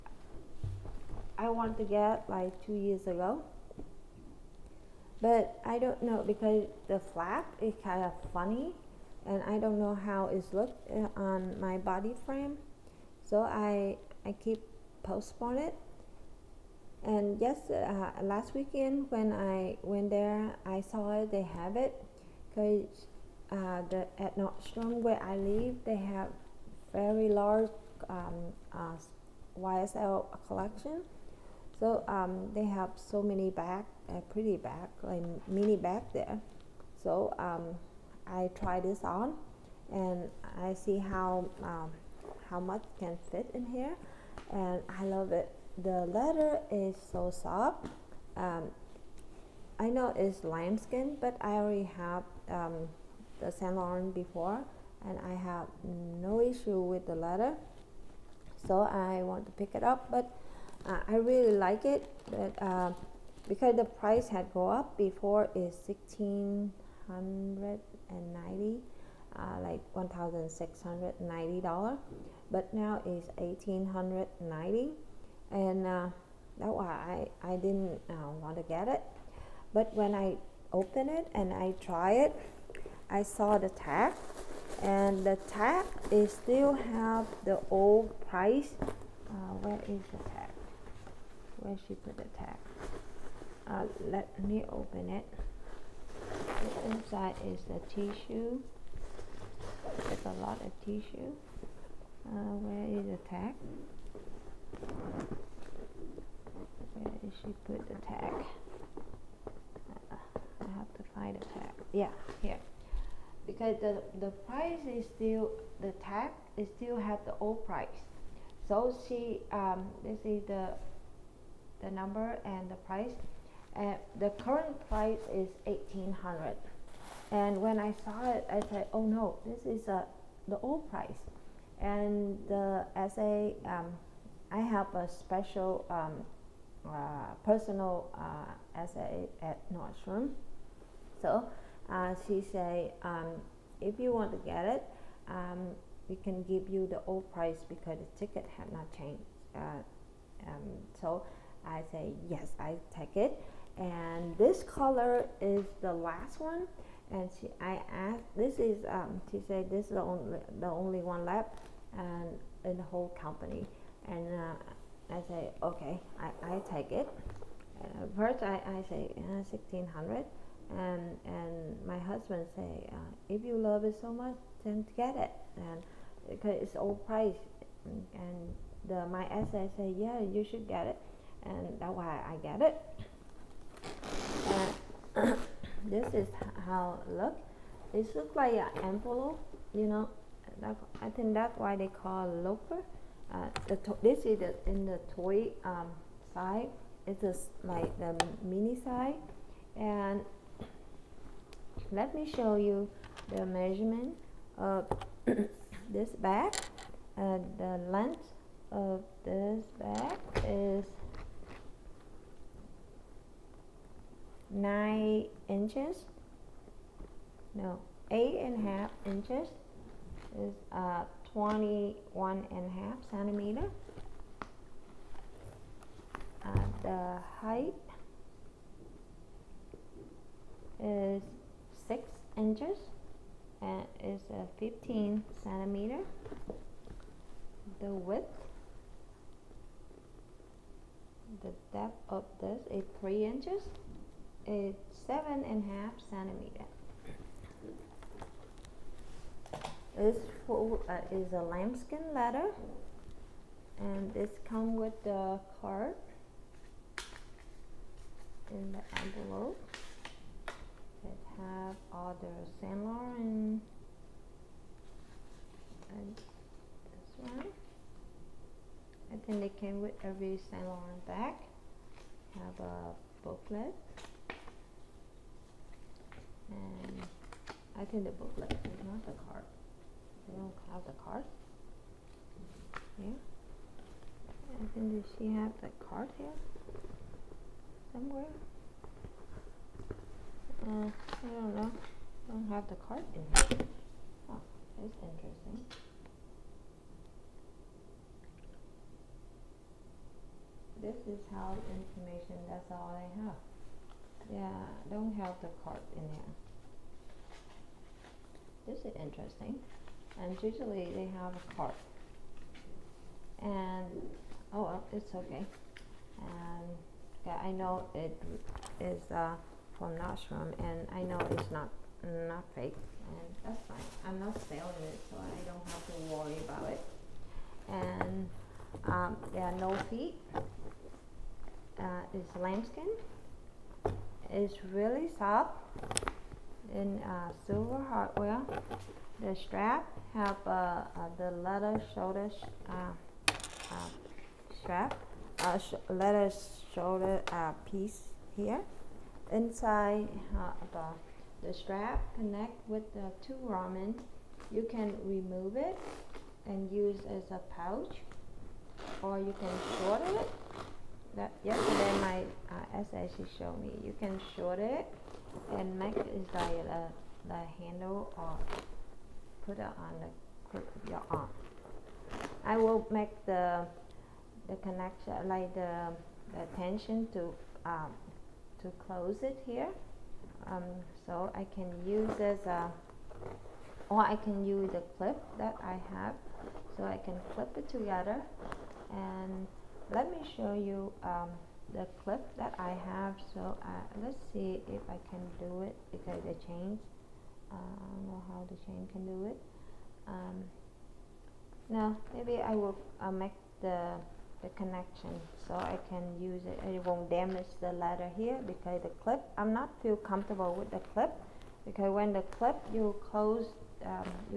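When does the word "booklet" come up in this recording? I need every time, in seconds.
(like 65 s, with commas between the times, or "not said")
273 s, 278 s.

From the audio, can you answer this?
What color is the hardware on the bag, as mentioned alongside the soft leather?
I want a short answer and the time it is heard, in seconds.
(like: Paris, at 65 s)
Silver, at 337 s.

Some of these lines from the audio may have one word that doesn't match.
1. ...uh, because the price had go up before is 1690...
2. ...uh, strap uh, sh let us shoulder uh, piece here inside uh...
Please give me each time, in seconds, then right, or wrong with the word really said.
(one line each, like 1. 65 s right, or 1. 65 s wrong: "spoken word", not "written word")
1. 62 s right
2. 343 s right.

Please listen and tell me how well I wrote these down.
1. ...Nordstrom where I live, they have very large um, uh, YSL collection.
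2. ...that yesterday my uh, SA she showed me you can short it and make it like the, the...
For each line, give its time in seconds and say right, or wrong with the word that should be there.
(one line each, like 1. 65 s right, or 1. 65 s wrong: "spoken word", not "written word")
1. 24 s right
2. 361 s right.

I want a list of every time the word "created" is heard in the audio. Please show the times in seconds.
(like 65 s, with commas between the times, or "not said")
not said.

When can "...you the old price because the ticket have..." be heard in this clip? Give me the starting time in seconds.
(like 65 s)
146 s.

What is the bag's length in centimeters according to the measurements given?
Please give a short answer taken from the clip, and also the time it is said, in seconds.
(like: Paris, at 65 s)
21.5 centimeters, at 221 s.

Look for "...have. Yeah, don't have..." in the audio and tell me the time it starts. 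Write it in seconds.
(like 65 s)
303 s.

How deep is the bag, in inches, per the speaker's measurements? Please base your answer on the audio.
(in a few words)
3 inches.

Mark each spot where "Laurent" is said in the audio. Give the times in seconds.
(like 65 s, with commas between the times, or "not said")
53 s, 262 s, 270 s.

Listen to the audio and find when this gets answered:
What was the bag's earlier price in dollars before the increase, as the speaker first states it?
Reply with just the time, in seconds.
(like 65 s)
69 s.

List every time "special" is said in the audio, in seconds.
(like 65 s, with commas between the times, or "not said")
135 s.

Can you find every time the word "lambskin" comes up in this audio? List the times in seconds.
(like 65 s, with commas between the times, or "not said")
50 s, 251 s, 332 s.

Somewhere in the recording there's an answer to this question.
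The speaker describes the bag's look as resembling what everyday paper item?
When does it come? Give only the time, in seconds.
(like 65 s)
188 s.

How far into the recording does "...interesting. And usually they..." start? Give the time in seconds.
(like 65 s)
308 s.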